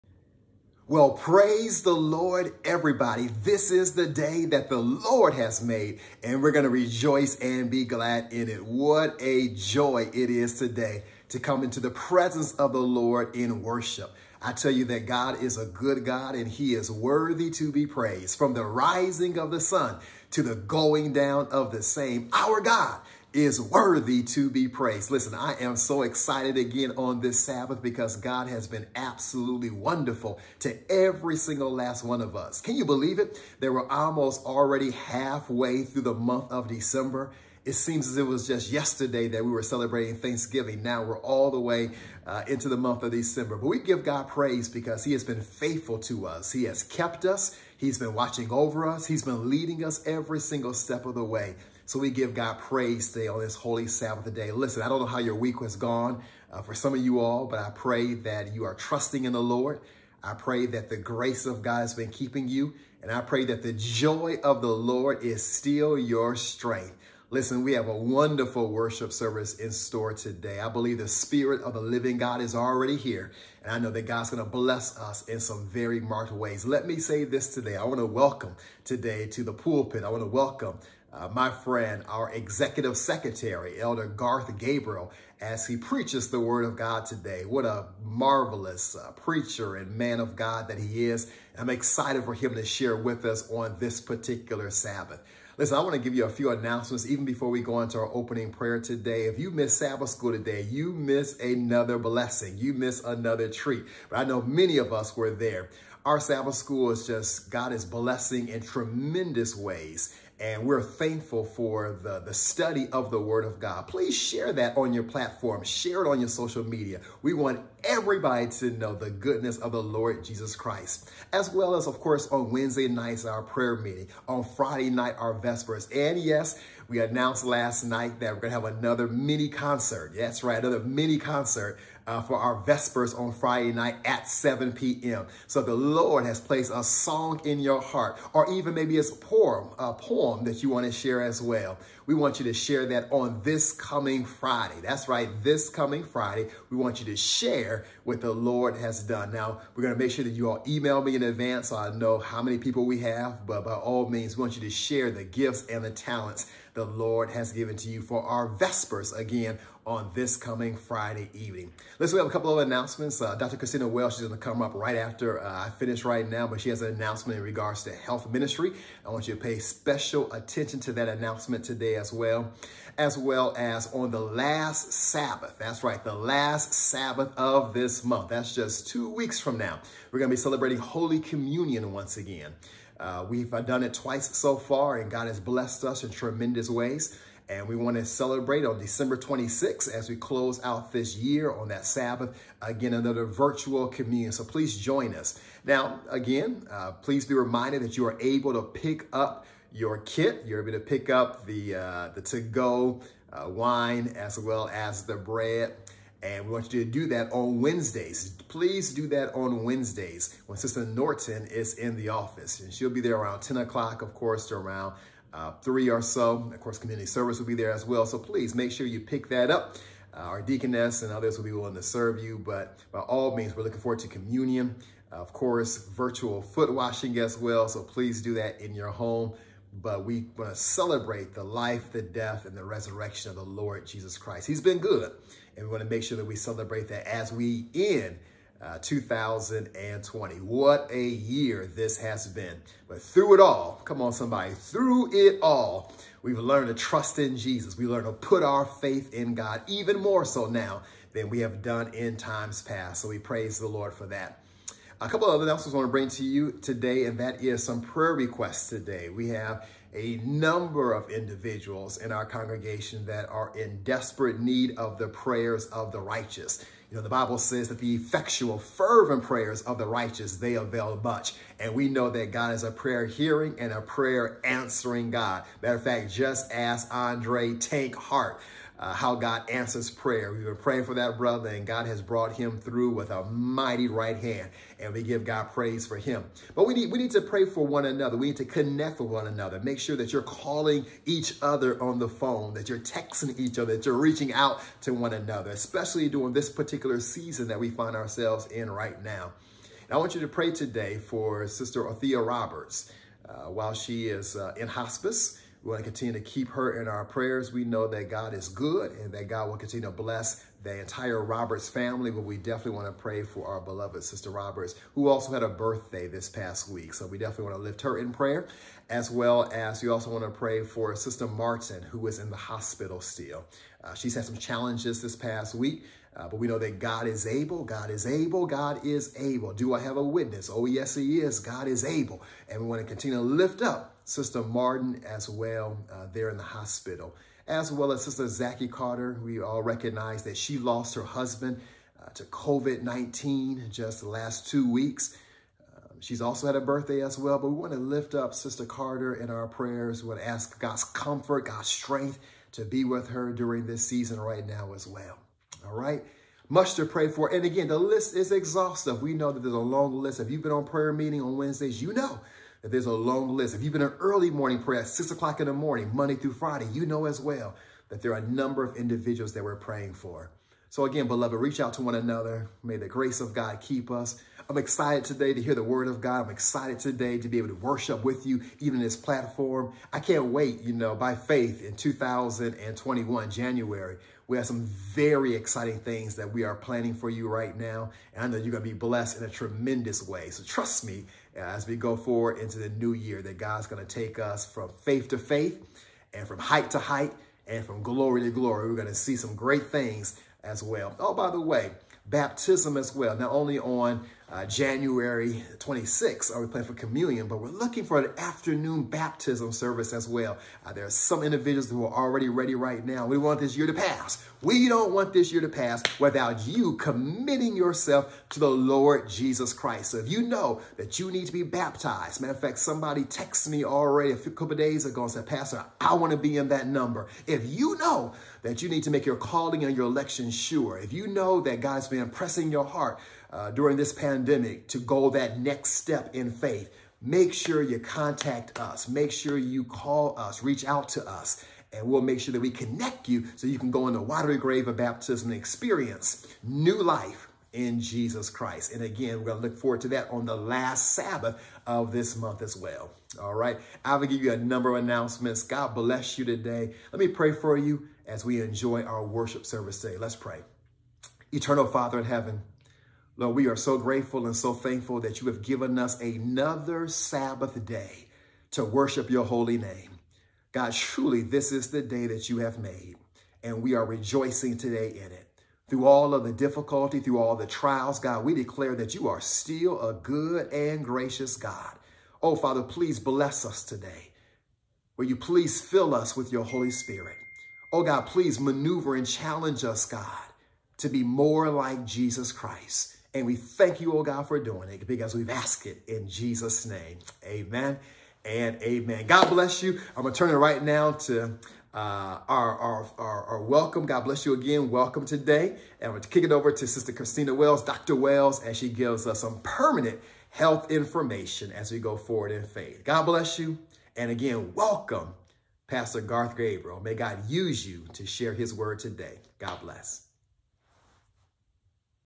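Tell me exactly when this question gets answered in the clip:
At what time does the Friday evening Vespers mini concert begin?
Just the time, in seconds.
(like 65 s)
134 s.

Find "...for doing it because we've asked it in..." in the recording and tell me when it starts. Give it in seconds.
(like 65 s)
494 s.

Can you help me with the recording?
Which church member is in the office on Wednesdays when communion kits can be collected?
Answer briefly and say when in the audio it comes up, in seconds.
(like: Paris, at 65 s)
Sister Norton, at 210 s.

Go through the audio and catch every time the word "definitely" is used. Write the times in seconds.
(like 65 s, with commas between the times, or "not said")
312 s, 317 s.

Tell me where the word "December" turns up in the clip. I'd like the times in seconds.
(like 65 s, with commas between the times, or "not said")
36 s, 43 s, 188 s.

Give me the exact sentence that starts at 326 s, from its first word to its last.
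Uh, but we know that God is able, God is able, God is able.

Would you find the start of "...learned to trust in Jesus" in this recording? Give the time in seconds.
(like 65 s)
246 s.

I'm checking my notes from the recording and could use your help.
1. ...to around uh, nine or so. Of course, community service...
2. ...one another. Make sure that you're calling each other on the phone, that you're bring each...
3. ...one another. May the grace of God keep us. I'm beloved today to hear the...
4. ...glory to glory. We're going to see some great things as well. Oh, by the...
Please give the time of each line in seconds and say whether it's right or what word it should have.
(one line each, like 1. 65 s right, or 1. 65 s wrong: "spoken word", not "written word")
1. 214 s wrong: "three", not "nine"
2. 289 s wrong: "texting", not "bring"
3. 371 s wrong: "excited", not "beloved"
4. 397 s right.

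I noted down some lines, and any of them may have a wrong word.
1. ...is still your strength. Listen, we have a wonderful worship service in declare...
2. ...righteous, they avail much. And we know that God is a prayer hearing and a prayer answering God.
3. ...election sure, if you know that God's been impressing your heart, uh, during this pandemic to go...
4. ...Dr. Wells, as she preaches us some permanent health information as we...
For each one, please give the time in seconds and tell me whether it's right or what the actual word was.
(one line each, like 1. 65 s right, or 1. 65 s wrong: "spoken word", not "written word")
1. 65 s wrong: "store", not "declare"
2. 269 s right
3. 429 s right
4. 507 s wrong: "gives", not "preaches".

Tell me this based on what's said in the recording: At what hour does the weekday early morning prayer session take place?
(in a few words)
6 o'clock.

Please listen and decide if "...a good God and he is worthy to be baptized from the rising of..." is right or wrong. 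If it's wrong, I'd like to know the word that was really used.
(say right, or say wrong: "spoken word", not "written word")
wrong: "praised", not "baptized".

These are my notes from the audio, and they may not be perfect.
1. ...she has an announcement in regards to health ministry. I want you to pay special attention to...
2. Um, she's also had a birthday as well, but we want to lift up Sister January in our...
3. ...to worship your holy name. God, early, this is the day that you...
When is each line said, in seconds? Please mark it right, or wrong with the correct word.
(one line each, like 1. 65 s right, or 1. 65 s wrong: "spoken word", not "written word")
1. 166 s right
2. 345 s wrong: "Carter", not "January"
3. 468 s wrong: "truly", not "early".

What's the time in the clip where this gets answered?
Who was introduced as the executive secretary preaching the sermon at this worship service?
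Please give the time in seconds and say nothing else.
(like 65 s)
83 s.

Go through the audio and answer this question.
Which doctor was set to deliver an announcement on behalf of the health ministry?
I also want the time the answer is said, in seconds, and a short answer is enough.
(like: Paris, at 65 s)
Dr. Christina Welsh, at 163 s.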